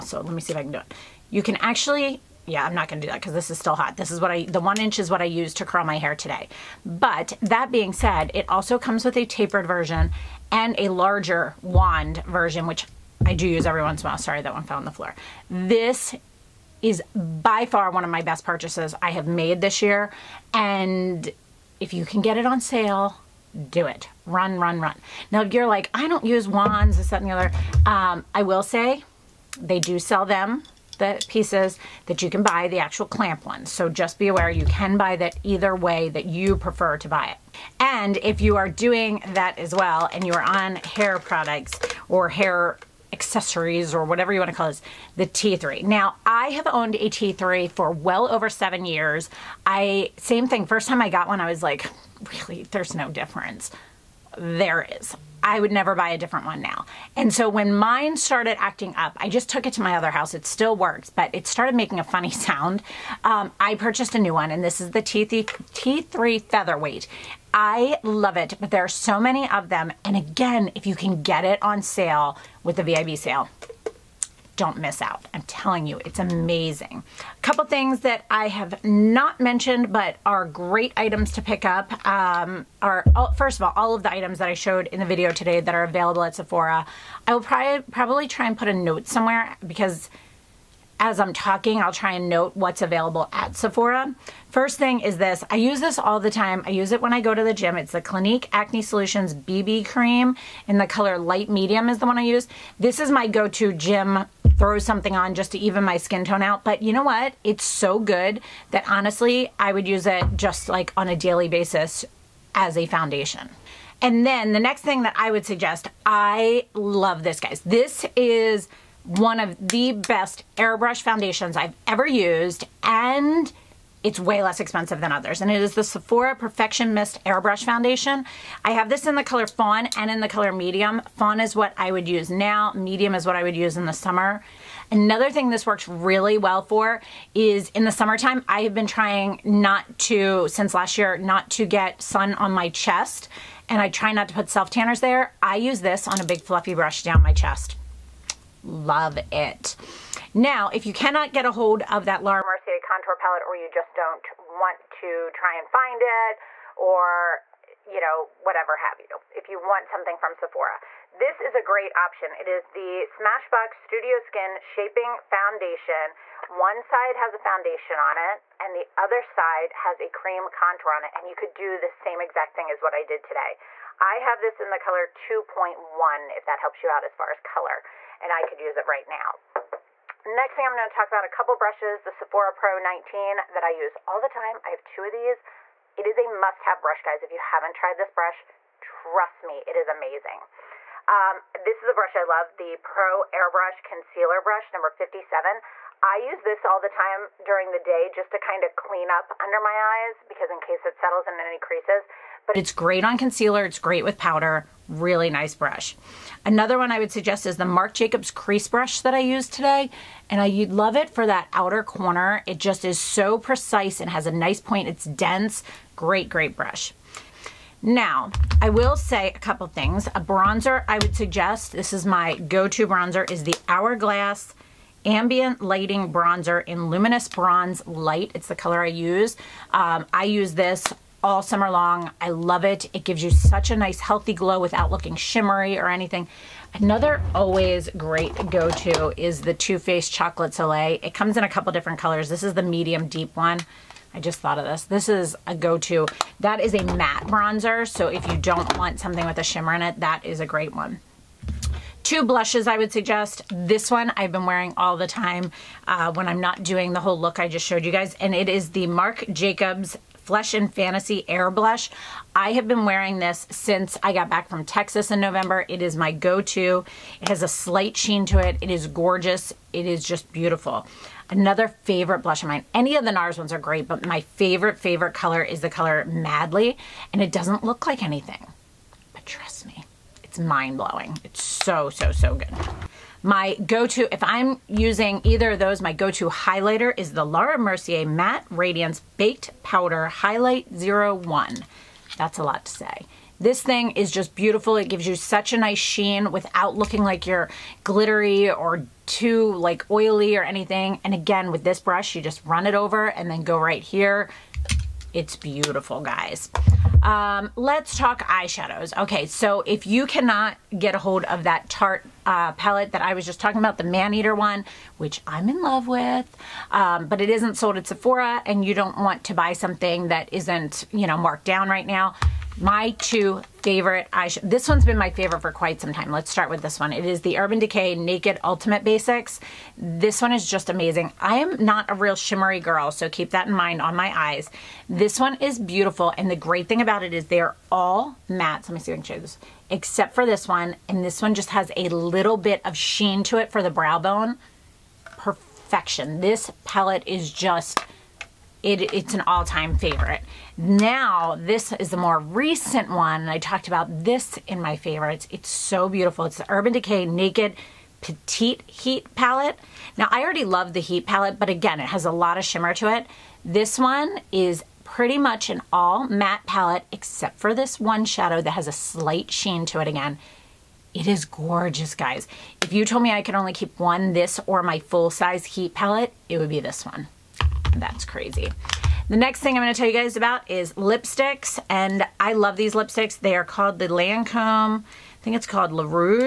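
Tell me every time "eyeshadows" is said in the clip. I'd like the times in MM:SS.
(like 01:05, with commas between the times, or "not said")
05:08, 05:24.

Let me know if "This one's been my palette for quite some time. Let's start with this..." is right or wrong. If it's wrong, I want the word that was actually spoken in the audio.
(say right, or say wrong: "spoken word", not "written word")
wrong: "favorite", not "palette".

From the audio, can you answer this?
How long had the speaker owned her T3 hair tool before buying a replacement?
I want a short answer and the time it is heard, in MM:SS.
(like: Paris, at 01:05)
over 7 years, at 00:47.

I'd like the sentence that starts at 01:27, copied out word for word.
I will probably, probably try and put a note somewhere because as I'm talking, I'll try and note what's available at Sephora.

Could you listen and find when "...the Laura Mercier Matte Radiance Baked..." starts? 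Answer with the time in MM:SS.
04:47.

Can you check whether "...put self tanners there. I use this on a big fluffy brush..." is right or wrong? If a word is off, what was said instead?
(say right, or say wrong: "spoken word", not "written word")
right.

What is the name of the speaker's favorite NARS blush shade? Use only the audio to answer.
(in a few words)
Madly.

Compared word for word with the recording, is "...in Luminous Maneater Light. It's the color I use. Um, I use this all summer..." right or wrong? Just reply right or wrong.
wrong.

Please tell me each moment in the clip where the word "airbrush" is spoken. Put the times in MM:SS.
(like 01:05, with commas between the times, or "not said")
02:00, 02:07, 03:13.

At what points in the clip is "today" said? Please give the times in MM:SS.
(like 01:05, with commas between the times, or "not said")
00:06, 01:25, 02:53, 03:29.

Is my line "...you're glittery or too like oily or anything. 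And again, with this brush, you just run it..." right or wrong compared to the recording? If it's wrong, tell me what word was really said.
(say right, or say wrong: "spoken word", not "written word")
right.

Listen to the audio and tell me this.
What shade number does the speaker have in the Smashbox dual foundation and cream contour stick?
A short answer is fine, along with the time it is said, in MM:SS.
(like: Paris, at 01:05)
2.1, at 02:55.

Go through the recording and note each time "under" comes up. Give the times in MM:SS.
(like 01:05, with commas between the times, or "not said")
03:19.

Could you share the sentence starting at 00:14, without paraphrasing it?
Sorry, that one fell on the floor.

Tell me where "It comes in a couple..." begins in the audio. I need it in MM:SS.
04:01.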